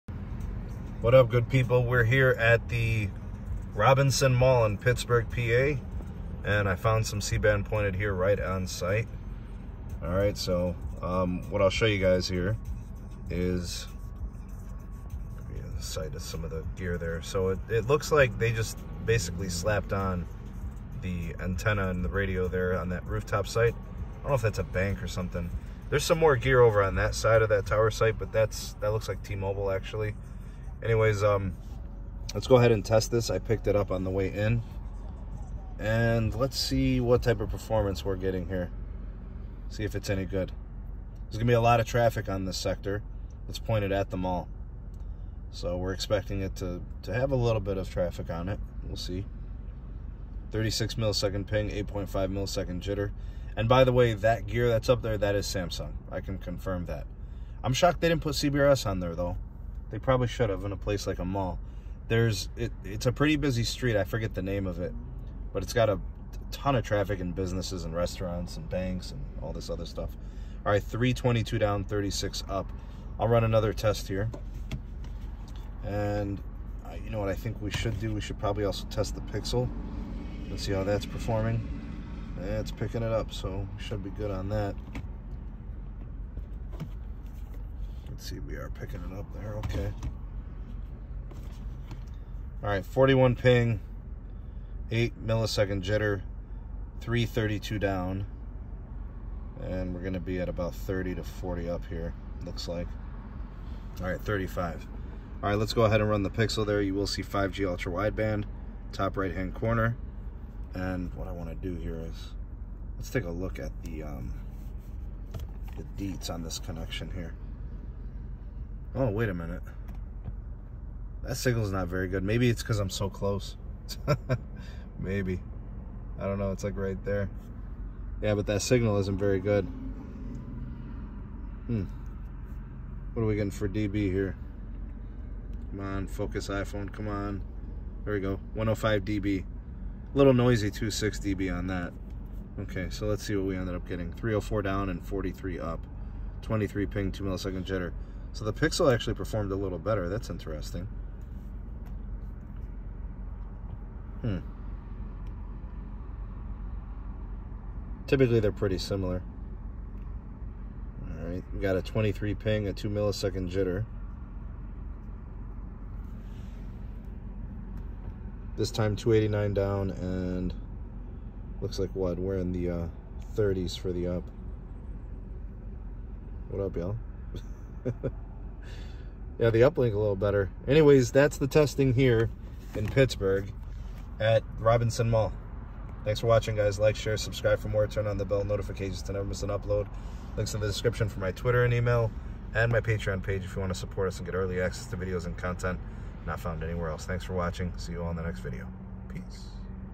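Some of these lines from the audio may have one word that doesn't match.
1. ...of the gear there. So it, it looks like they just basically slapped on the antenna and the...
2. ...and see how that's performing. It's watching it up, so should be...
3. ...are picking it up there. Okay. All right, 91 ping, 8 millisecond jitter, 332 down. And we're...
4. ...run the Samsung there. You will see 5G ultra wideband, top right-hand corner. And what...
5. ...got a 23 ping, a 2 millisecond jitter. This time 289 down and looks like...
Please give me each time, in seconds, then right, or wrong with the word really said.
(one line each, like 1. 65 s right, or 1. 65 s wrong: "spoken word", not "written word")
1. 16 s right
2. 80 s wrong: "picking", not "watching"
3. 88 s wrong: "41", not "91"
4. 106 s wrong: "Pixel", not "Samsung"
5. 161 s right.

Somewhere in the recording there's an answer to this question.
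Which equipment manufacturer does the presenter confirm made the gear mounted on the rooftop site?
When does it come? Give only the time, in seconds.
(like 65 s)
55 s.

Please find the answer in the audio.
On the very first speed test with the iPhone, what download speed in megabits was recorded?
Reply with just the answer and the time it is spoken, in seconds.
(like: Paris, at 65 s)
322, at 70 s.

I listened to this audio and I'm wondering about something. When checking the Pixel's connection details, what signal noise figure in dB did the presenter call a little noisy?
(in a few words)
2.6 dB.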